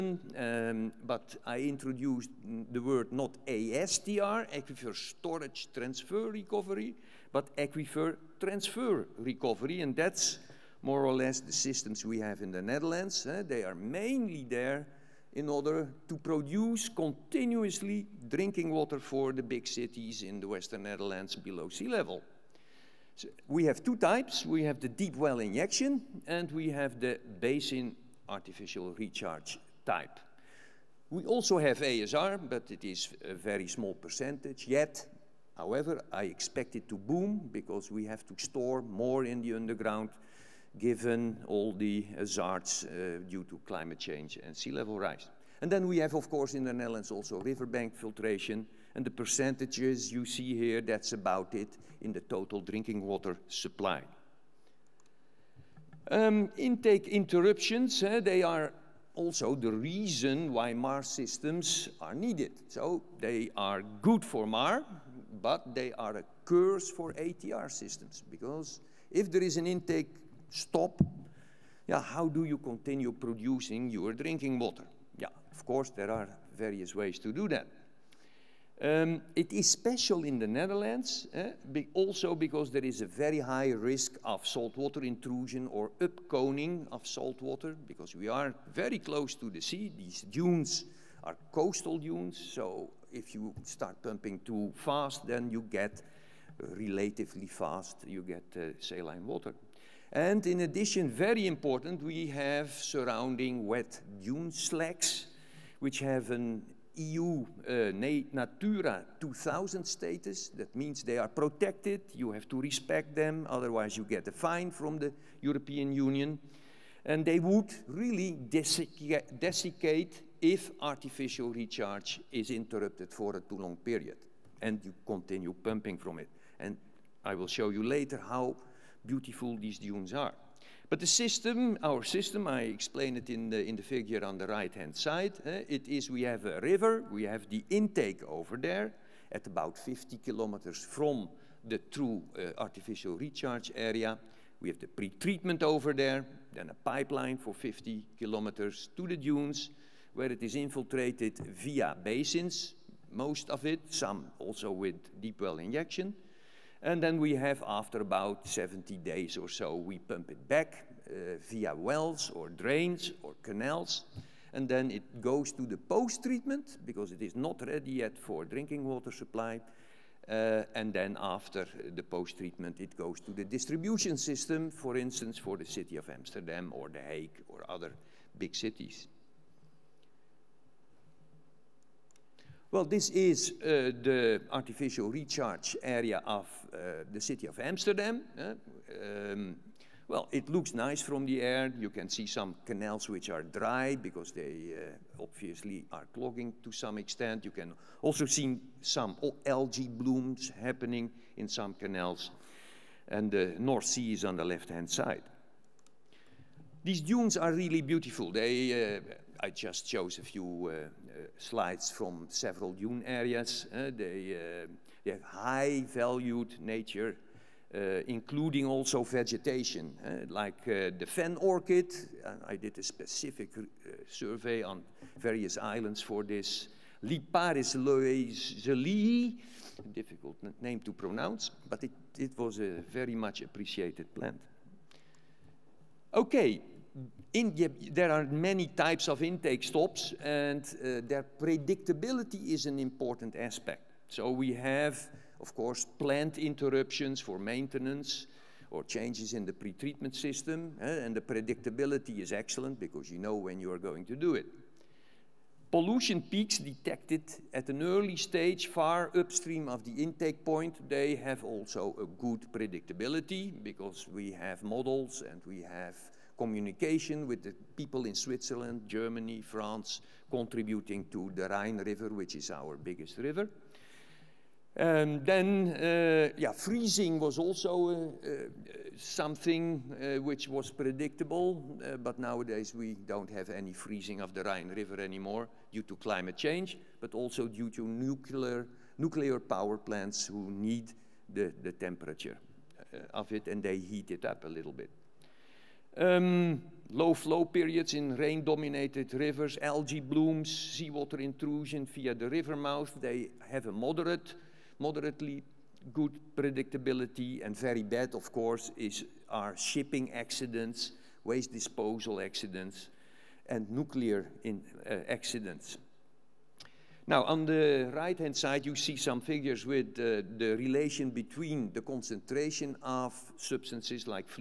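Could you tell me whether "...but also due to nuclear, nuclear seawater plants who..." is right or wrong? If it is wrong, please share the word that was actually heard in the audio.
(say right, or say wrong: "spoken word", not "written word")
wrong: "power", not "seawater".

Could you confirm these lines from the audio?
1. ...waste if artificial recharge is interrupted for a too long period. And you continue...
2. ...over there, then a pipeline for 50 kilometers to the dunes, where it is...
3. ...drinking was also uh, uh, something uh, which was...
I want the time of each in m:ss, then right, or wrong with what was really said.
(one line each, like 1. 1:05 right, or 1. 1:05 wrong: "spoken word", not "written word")
1. 1:58 wrong: "desiccate", not "waste"
2. 2:25 right
3. 4:36 wrong: "freezing", not "drinking".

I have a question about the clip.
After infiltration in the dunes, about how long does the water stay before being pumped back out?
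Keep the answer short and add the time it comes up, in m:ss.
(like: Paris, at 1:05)
70 days, at 2:38.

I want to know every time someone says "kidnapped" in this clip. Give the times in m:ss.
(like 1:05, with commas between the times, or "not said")
not said.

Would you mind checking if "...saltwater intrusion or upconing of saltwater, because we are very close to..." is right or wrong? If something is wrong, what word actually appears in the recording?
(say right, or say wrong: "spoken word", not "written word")
right.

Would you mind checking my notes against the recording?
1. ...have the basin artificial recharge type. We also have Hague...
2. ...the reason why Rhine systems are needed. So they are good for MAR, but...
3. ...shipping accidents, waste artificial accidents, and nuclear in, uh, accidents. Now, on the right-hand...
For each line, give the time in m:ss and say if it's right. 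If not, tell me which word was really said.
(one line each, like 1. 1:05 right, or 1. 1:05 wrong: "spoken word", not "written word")
1. 0:26 wrong: "ASR", not "Hague"
2. 0:59 wrong: "MAR", not "Rhine"
3. 5:09 wrong: "disposal", not "artificial".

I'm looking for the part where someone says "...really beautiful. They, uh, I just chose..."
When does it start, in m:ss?
3:27.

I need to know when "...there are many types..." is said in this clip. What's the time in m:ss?
3:57.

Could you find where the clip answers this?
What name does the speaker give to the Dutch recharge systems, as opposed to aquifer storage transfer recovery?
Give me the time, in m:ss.
0:07.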